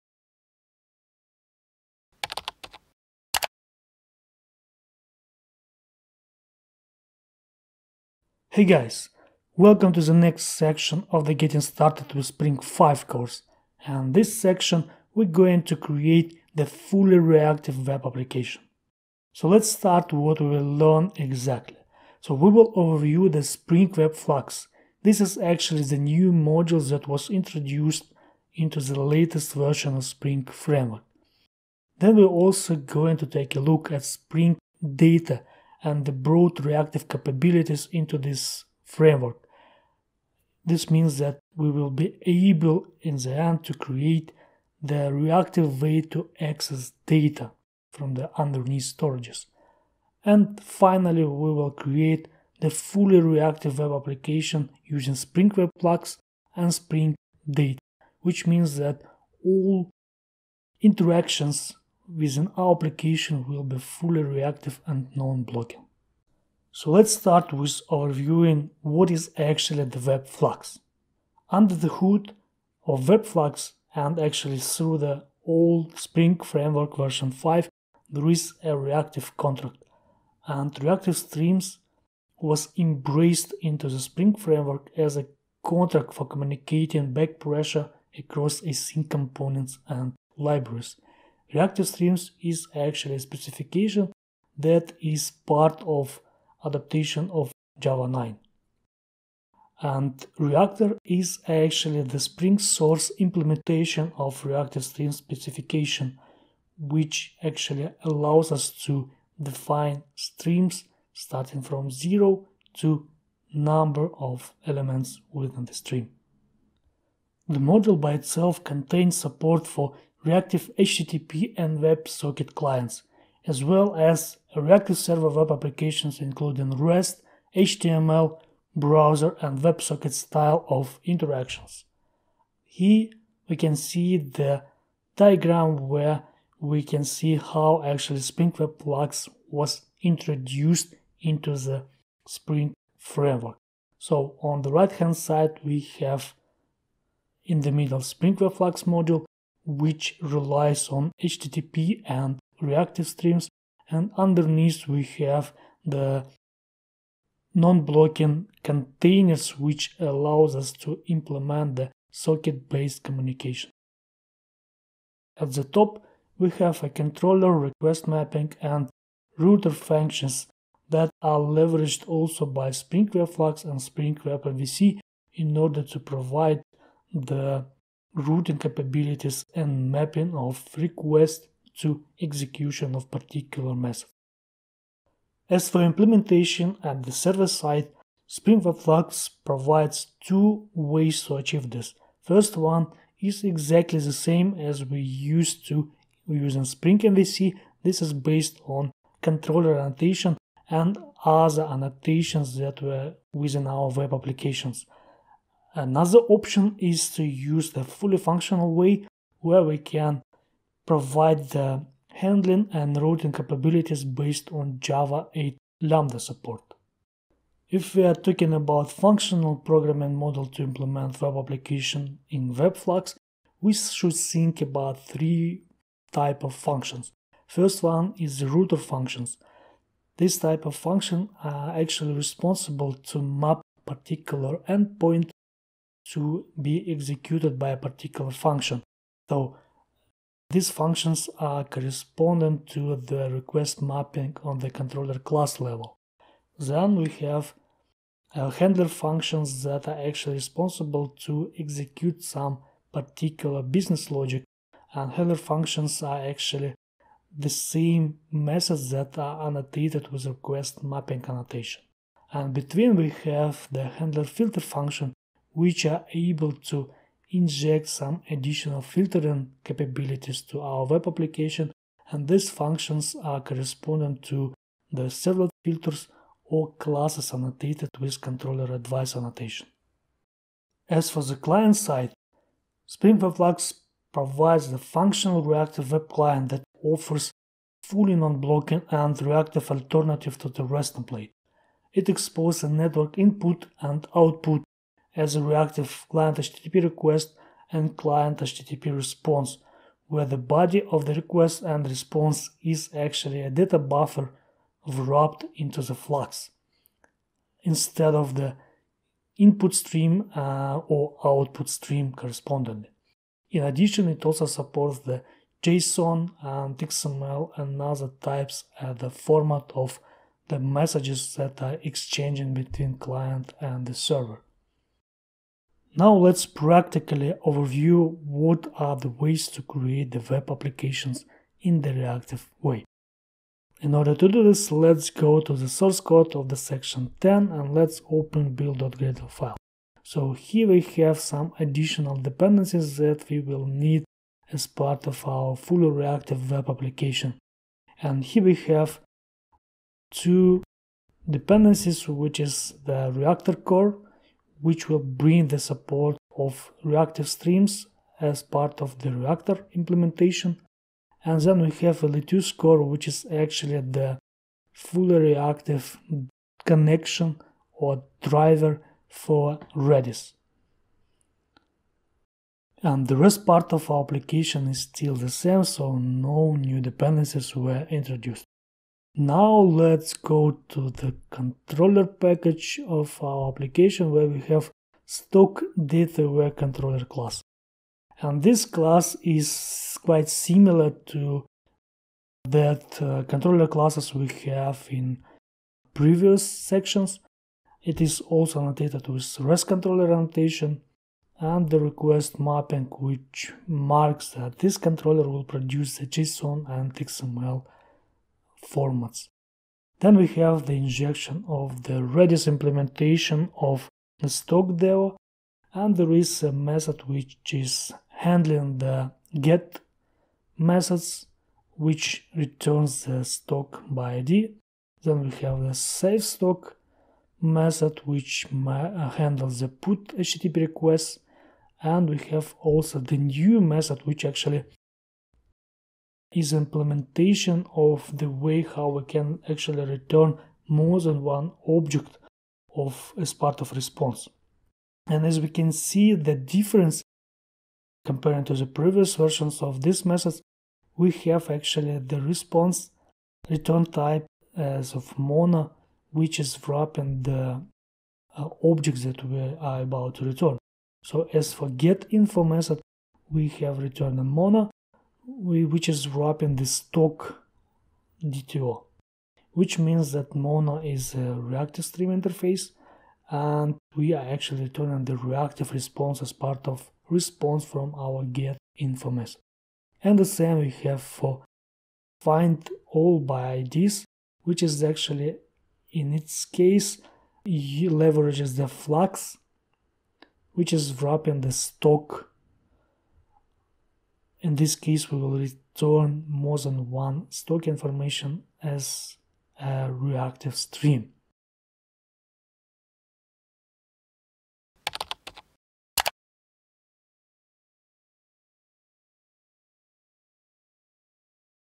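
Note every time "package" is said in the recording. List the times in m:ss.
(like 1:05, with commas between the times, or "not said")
6:22.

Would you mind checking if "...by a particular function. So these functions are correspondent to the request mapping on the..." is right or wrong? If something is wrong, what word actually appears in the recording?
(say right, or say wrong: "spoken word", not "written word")
right.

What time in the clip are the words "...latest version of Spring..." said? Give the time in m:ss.
0:28.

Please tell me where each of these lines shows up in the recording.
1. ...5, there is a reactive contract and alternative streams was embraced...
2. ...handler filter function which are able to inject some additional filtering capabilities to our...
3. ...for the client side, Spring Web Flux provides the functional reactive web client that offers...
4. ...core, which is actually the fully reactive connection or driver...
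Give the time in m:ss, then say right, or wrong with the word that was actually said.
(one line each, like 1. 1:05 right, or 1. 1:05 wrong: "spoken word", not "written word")
1. 1:17 wrong: "reactive", not "alternative"
2. 4:23 right
3. 4:41 right
4. 6:02 right.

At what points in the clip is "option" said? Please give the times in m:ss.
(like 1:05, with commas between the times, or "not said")
3:26.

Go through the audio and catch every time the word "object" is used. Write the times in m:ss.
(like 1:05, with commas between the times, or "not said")
7:21, 7:38.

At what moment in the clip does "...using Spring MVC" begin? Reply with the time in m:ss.
3:16.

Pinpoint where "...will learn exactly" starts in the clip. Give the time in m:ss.
0:20.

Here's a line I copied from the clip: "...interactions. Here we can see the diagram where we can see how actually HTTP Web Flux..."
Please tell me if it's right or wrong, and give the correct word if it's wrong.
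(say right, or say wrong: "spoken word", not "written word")
wrong: "Spring", not "HTTP".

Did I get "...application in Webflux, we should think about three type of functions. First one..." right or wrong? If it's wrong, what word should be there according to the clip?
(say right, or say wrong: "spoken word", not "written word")
right.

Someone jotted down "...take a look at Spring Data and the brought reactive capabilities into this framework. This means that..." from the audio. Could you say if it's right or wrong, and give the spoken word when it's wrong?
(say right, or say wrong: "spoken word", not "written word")
right.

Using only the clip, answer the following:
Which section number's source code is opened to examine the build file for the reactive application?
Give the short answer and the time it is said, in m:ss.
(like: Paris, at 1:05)
10, at 5:36.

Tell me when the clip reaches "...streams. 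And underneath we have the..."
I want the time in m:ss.
2:33.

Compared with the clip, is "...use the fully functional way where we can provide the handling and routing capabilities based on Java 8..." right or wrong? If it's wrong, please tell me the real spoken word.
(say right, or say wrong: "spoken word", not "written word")
right.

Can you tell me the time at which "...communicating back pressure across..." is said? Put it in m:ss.
1:26.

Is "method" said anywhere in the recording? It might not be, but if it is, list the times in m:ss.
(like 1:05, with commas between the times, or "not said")
3:03, 4:18, 6:56, 7:00, 7:07, 7:13, 7:30, 7:42.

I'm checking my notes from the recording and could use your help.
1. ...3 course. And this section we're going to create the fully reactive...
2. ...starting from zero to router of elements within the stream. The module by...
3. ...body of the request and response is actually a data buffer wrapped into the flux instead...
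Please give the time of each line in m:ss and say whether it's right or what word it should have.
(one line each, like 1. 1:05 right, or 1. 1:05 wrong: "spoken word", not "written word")
1. 0:12 wrong: "5", not "3"
2. 1:51 wrong: "number", not "router"
3. 5:00 right.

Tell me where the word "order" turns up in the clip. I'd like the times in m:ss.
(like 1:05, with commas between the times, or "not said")
2:55, 5:33.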